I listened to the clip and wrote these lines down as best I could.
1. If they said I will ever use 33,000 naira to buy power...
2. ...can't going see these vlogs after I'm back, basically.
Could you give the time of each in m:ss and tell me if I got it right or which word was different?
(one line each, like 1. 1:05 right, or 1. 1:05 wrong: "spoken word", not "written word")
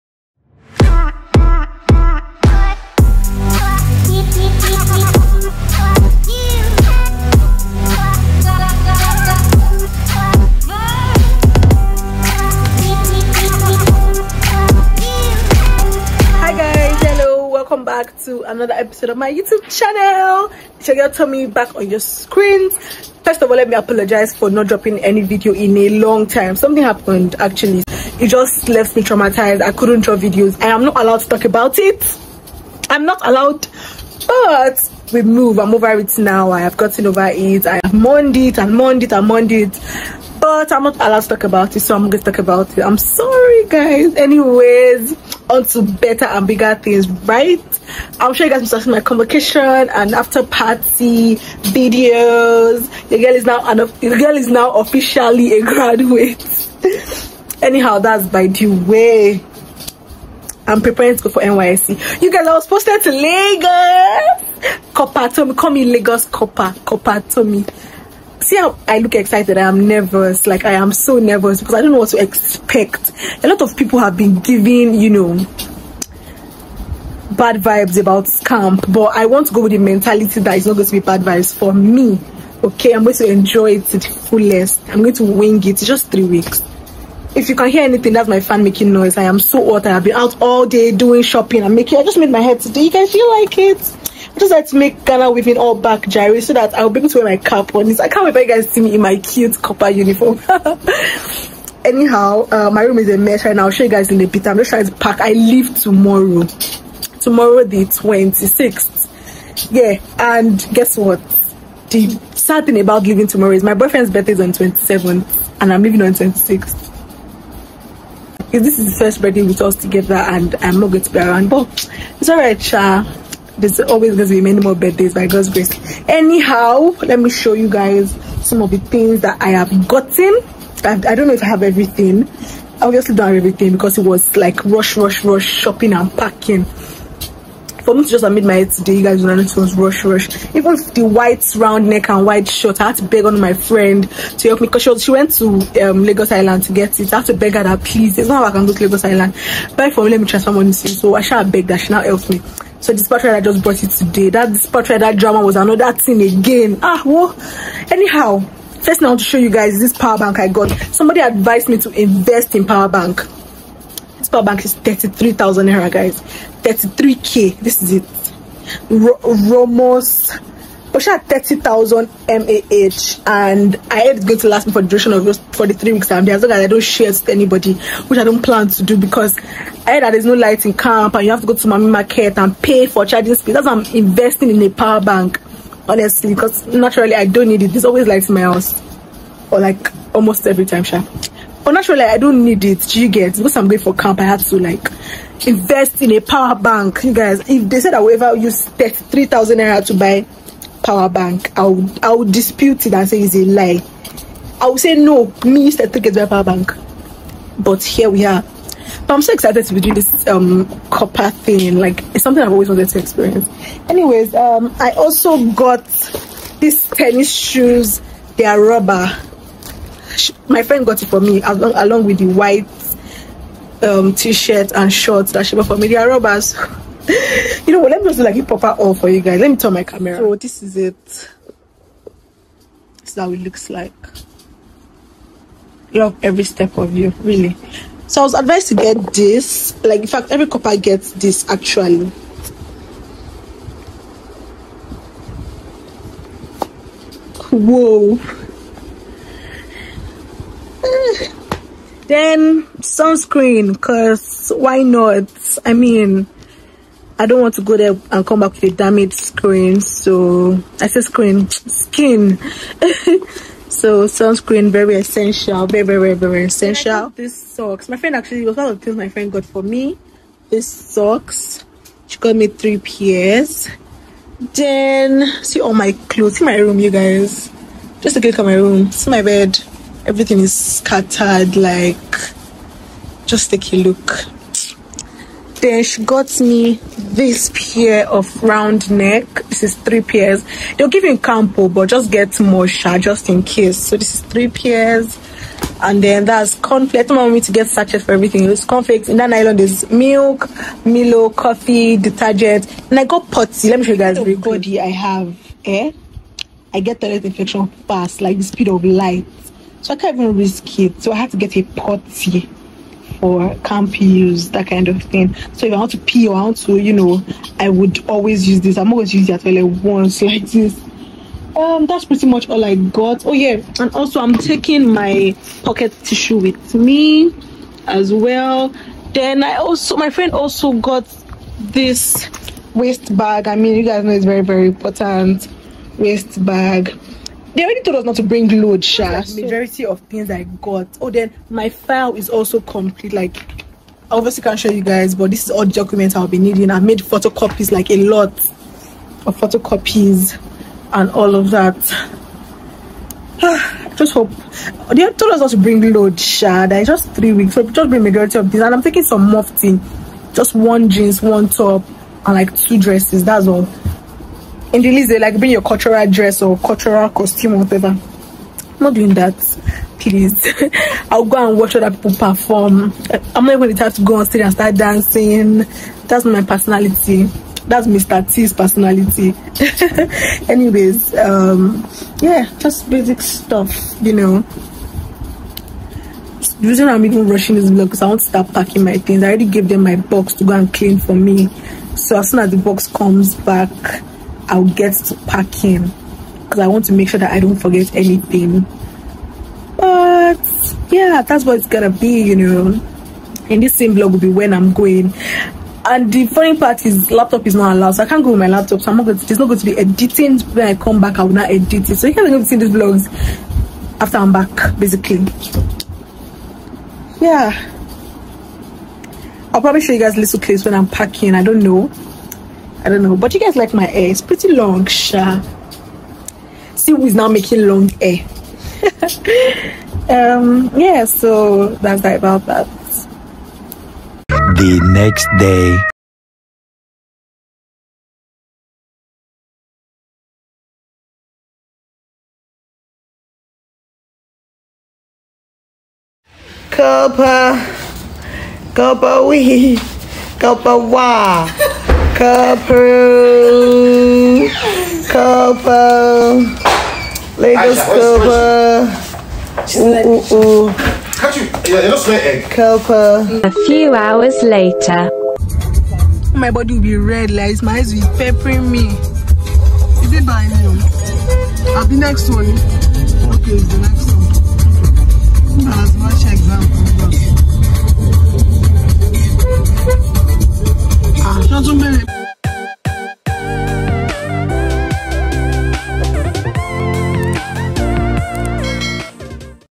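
1. 3:17 right
2. 6:52 right.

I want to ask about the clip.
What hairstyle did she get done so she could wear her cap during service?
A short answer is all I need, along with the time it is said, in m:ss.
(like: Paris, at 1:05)
Ghana weaving, at 1:35.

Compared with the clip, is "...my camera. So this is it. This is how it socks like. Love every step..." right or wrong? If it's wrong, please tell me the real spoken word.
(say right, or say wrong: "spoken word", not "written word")
wrong: "looks", not "socks".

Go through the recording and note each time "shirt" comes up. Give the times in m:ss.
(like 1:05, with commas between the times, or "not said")
2:22, 3:44.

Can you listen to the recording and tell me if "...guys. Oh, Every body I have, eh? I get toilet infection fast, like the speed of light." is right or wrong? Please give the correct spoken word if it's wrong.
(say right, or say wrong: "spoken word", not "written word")
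right.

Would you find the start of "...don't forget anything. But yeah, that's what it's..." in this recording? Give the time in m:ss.
6:37.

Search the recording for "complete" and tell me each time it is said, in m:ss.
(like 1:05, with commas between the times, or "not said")
5:42.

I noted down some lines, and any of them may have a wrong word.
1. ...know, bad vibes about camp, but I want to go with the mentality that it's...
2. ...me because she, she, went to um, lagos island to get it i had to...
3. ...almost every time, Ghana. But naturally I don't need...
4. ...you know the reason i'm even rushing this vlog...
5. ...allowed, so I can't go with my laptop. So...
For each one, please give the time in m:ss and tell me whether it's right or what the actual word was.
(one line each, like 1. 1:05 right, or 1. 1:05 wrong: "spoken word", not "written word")
1. 1:15 right
2. 2:24 right
3. 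3:10 wrong: "Sha", not "Ghana"
4. 6:24 right
5. 6:47 right.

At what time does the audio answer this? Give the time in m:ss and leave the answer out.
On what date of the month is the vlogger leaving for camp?
1:47.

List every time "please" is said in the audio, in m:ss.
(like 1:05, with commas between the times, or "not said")
2:27, 6:09.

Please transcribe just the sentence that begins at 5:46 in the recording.
I made photocopies, like a lot of photocopies and all of that.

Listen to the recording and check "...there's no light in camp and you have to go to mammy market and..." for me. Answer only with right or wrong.
right.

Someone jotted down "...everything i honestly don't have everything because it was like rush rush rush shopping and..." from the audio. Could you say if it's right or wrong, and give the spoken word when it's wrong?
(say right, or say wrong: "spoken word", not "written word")
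wrong: "obviously", not "honestly".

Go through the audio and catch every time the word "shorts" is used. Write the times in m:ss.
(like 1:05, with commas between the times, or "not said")
3:44.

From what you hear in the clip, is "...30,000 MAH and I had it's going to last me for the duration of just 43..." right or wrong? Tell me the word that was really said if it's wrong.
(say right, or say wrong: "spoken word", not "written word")
right.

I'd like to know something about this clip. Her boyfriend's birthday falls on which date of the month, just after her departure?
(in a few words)
27th.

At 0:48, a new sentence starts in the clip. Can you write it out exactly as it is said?
I'm sure you guys must have my convocation and after party videos.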